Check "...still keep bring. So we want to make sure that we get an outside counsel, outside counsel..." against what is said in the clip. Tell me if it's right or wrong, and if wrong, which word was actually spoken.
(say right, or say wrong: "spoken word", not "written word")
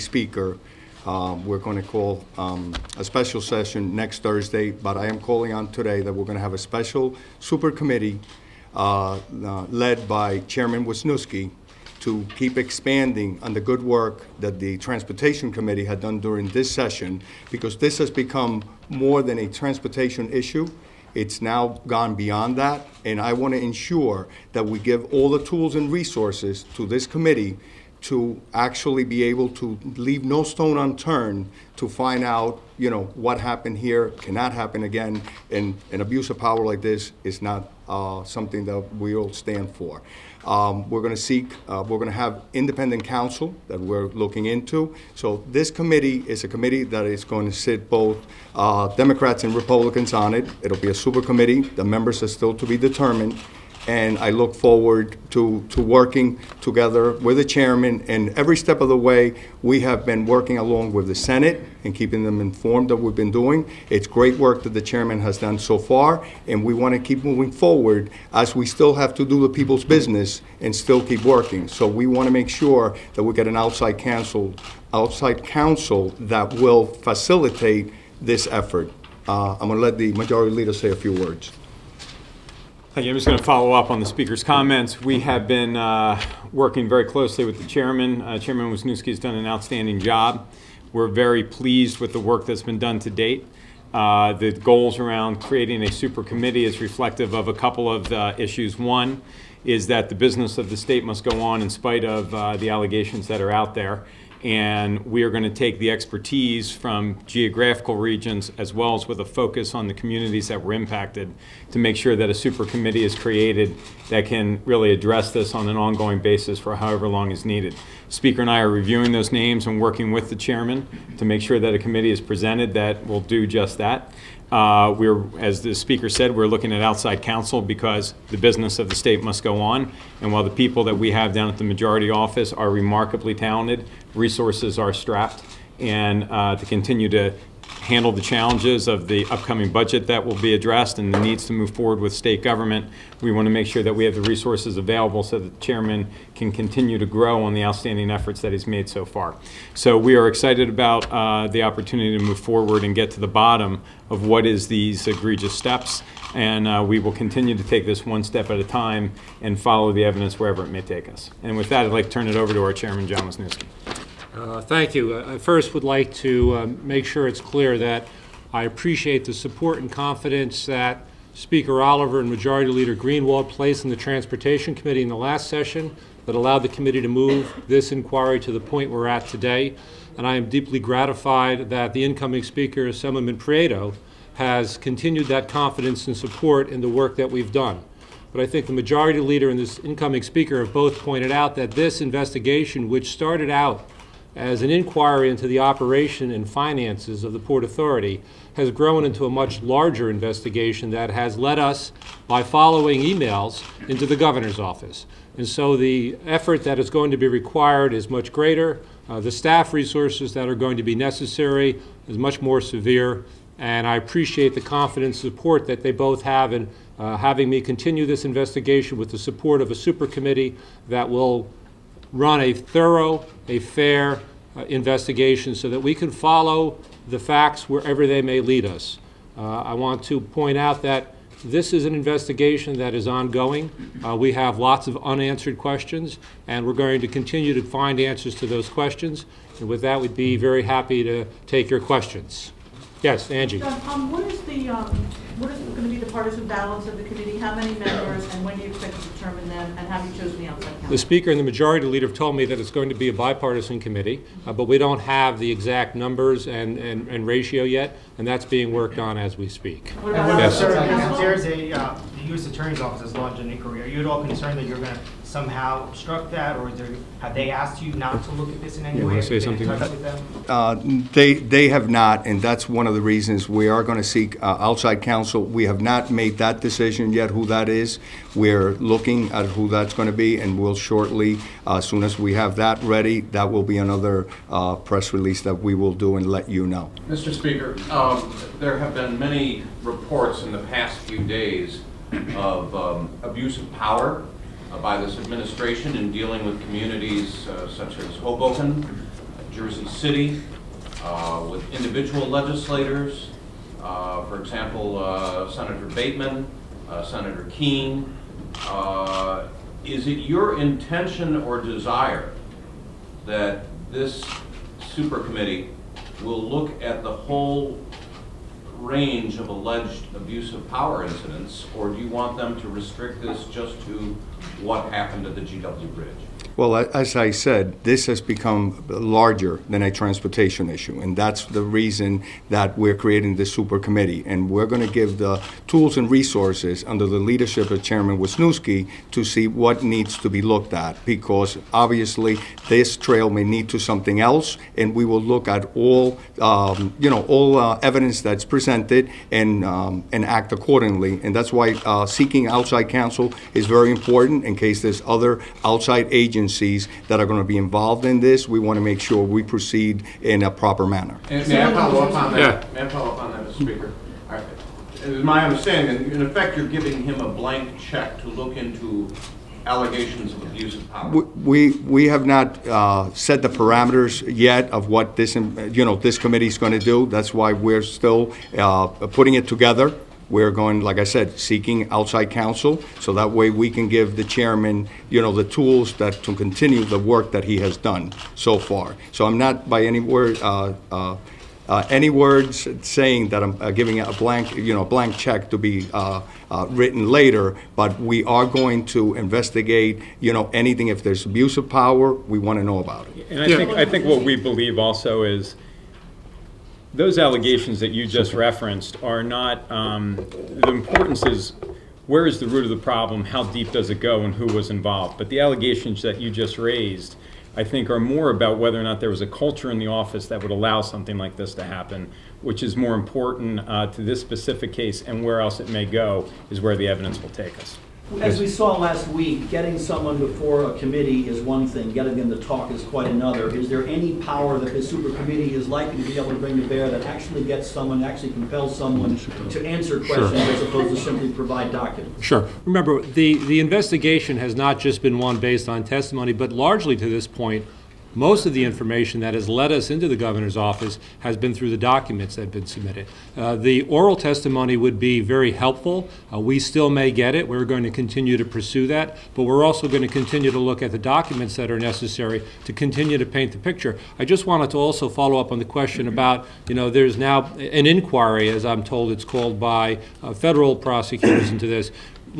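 wrong: "working", not "bring".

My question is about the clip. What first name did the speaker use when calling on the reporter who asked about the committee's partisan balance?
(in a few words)
Angie.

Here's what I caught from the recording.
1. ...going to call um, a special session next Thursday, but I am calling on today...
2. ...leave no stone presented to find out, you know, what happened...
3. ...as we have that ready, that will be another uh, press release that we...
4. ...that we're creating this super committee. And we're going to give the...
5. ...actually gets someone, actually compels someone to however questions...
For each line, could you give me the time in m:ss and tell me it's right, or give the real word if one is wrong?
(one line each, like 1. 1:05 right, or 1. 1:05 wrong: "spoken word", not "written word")
1. 0:01 right
2. 0:29 wrong: "unturned", not "presented"
3. 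4:42 right
4. 5:32 right
5. 7:17 wrong: "answer", not "however".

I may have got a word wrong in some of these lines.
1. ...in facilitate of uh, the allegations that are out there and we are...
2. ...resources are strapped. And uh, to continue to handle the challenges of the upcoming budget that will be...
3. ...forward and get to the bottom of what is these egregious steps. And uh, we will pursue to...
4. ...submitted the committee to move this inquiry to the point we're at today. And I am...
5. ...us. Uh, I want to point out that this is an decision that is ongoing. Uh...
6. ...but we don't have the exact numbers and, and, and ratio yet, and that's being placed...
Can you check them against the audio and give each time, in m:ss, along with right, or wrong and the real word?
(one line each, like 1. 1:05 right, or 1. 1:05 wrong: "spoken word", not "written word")
1. 1:41 wrong: "spite", not "facilitate"
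2. 2:14 right
3. 2:32 wrong: "continue", not "pursue"
4. 2:56 wrong: "allowed", not "submitted"
5. 3:48 wrong: "investigation", not "decision"
6. 4:14 wrong: "worked", not "placed".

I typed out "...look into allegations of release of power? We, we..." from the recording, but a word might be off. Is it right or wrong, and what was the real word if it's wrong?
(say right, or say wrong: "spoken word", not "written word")
wrong: "abuse", not "release".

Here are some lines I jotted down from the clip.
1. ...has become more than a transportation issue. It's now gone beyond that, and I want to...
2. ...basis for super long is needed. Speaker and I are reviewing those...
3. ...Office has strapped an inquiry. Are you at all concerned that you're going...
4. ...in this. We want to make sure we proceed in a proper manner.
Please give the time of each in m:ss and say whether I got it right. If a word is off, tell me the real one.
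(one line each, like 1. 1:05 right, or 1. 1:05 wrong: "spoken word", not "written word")
1. 0:17 right
2. 1:56 wrong: "however", not "super"
3. 4:22 wrong: "launched", not "strapped"
4. 5:58 right.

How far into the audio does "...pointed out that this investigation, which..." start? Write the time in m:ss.
3:10.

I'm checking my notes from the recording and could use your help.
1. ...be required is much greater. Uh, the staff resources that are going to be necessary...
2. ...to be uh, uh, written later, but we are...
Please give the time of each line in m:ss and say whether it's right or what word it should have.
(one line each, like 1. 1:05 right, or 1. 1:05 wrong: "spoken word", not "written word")
1. 3:27 right
2. 6:35 right.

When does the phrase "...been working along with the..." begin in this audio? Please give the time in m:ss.
1:00.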